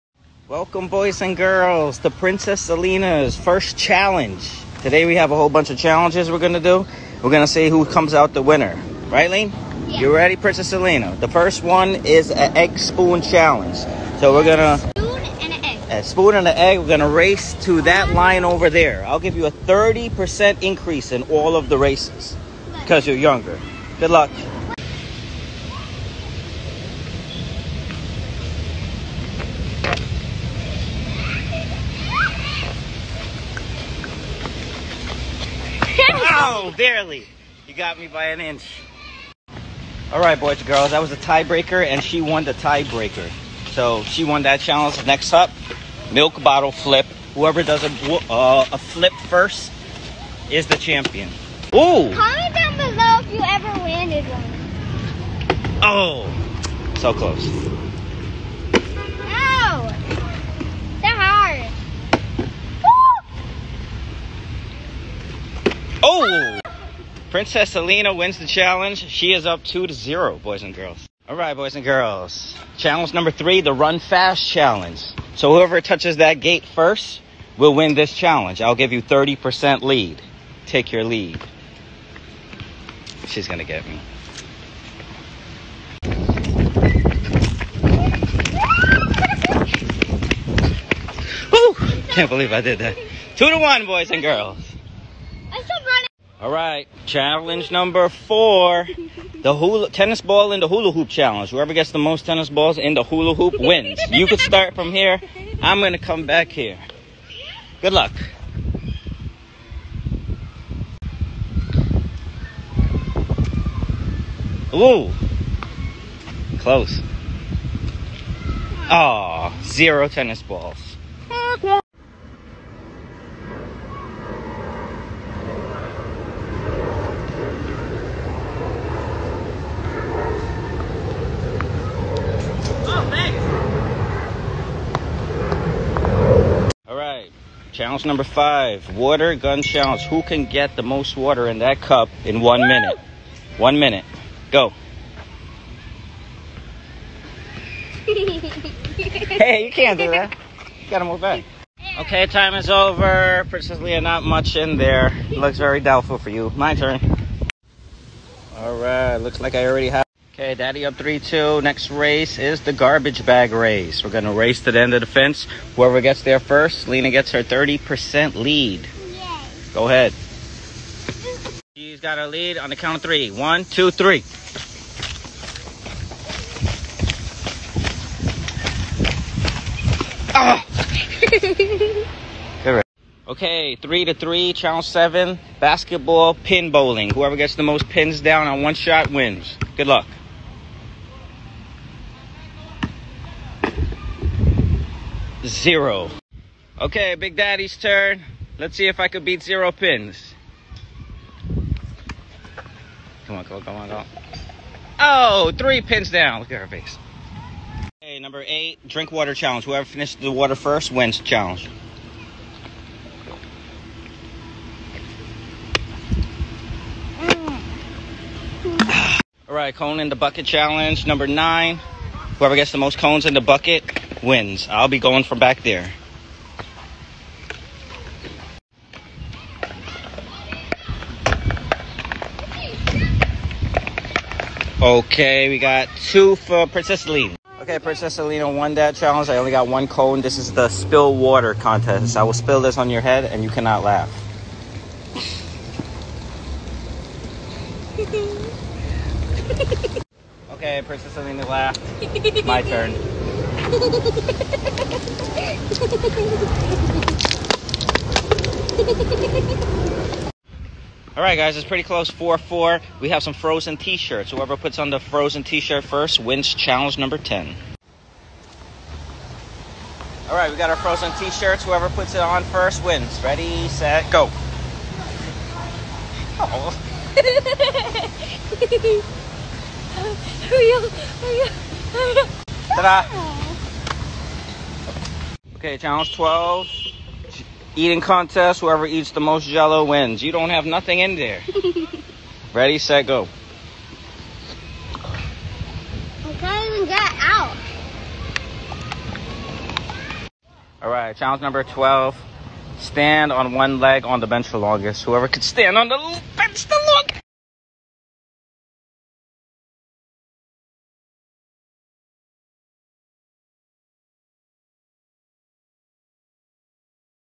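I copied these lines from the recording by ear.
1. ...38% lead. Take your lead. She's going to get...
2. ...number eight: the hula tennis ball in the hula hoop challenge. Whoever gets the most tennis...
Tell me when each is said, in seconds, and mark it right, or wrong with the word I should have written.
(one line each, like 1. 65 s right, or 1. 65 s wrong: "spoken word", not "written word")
1. 79 s wrong: "30", not "38"
2. 97 s wrong: "four", not "eight".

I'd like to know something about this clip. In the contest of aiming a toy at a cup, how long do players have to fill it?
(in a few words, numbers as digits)
1 minute.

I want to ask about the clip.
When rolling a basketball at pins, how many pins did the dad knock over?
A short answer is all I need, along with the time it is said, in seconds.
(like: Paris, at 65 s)
3, at 205 s.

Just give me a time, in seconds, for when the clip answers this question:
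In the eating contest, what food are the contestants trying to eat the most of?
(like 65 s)
289 s.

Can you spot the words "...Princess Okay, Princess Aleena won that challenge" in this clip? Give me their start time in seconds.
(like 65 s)
236 s.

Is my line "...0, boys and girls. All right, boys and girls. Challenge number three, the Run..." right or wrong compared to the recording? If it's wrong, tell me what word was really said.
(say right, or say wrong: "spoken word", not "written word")
right.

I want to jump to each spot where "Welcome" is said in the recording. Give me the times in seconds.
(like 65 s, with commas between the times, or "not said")
0 s.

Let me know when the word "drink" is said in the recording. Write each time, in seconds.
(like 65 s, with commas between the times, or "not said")
208 s.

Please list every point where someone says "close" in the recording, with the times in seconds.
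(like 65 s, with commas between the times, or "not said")
57 s, 116 s, 261 s.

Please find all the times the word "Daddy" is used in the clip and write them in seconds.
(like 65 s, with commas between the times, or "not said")
160 s, 197 s.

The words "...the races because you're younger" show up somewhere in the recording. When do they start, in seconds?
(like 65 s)
21 s.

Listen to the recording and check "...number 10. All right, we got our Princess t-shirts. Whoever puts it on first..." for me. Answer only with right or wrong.
wrong.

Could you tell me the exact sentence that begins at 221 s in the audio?
Number nine, whoever gets the most cones in the bucket wins.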